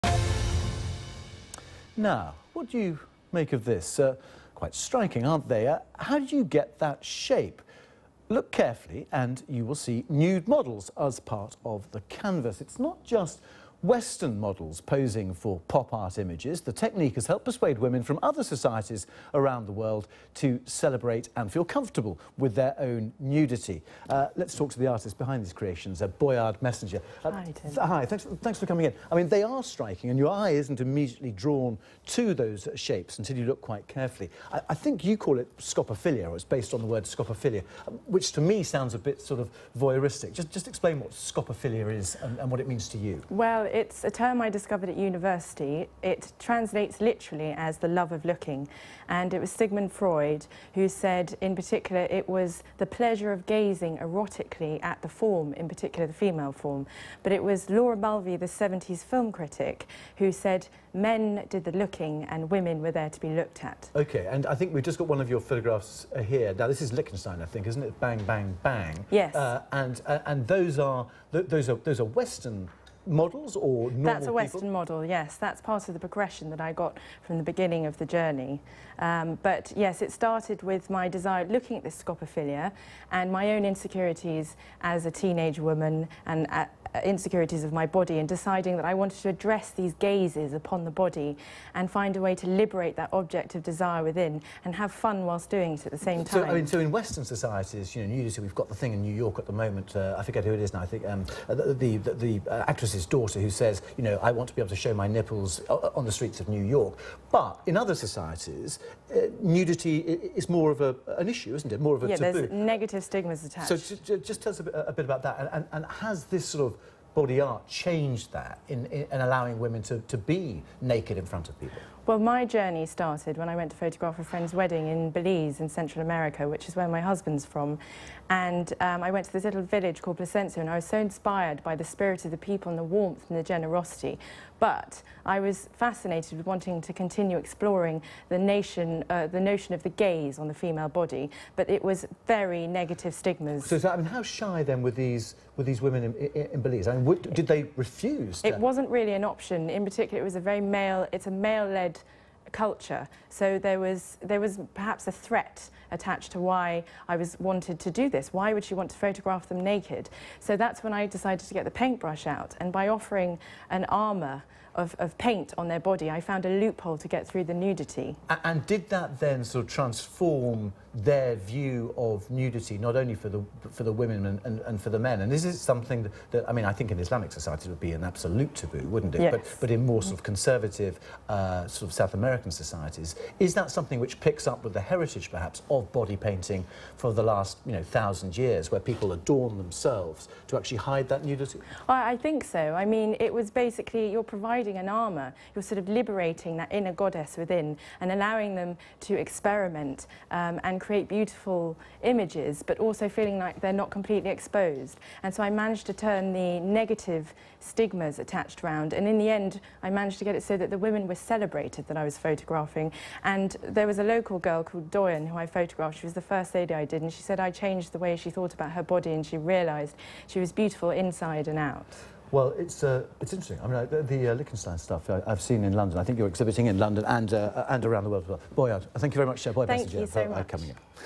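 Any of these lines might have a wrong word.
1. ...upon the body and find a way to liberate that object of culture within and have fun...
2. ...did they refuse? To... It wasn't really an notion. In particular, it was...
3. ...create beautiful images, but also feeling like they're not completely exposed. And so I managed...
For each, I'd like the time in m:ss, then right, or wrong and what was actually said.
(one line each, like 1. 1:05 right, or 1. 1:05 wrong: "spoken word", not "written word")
1. 1:30 wrong: "desire", not "culture"
2. 2:27 wrong: "option", not "notion"
3. 3:20 right.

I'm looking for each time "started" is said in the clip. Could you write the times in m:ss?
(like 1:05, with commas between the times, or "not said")
1:20, 2:02.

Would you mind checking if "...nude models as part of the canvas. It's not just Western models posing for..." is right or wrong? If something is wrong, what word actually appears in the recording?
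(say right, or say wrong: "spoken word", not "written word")
right.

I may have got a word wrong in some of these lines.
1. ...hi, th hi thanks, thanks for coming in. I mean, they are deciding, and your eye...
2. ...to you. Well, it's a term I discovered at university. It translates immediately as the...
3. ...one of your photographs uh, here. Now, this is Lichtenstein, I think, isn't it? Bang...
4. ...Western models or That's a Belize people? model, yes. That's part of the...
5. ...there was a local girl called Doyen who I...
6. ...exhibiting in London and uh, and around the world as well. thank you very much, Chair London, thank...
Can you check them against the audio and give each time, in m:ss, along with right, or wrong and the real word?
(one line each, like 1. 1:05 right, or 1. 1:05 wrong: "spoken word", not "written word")
1. 0:27 wrong: "striking", not "deciding"
2. 0:42 wrong: "literally", not "immediately"
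3. 1:05 right
4. 1:12 wrong: "Western", not "Belize"
5. 3:33 right
6. 3:46 wrong: "Boy", not "London".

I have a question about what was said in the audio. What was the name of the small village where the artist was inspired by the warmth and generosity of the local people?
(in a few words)
Placencia.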